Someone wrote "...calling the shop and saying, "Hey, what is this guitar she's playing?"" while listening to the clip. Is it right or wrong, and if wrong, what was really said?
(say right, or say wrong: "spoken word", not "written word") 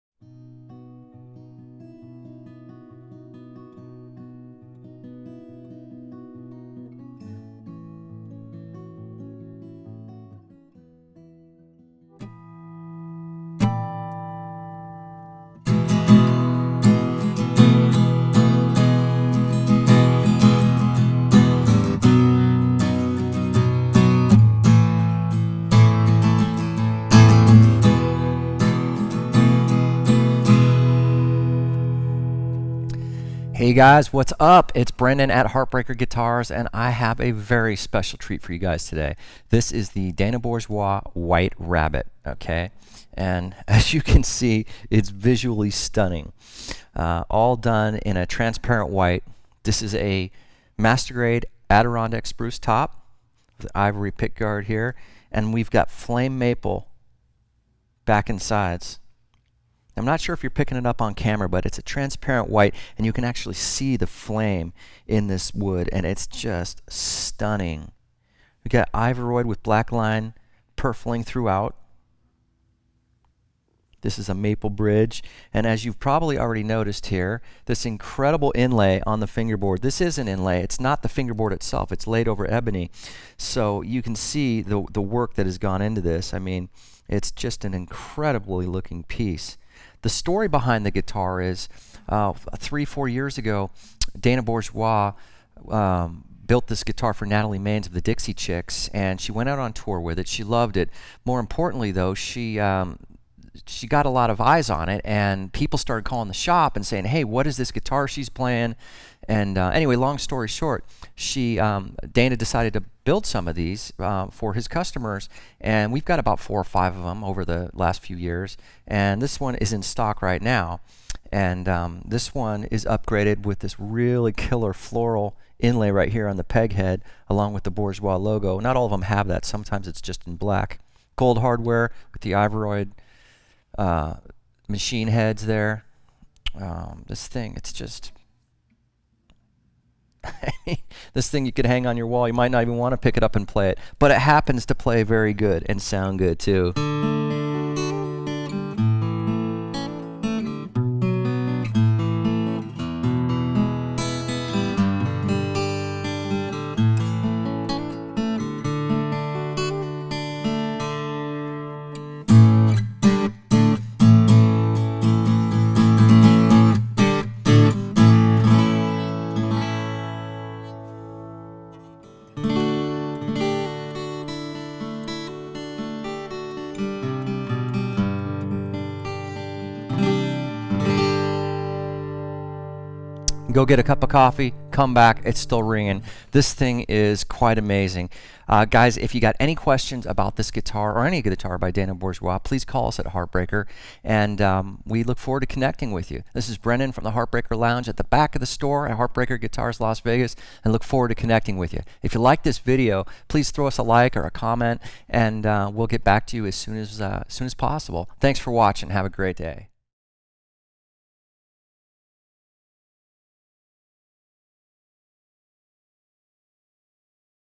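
right.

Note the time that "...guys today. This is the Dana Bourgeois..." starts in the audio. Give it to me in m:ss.
0:38.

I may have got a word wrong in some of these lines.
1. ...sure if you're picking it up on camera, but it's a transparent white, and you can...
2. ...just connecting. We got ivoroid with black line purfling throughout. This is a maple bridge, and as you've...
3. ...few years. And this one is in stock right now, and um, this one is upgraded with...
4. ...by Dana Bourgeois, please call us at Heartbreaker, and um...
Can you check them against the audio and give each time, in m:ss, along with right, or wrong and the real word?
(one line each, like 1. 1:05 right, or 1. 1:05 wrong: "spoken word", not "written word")
1. 1:00 right
2. 1:06 wrong: "stunning", not "connecting"
3. 1:58 right
4. 3:11 right.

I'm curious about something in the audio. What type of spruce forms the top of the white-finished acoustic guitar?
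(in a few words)
Adirondack spruce.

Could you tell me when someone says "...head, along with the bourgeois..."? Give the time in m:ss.
2:06.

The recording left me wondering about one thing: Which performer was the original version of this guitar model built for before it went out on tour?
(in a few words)
Natalie Maines.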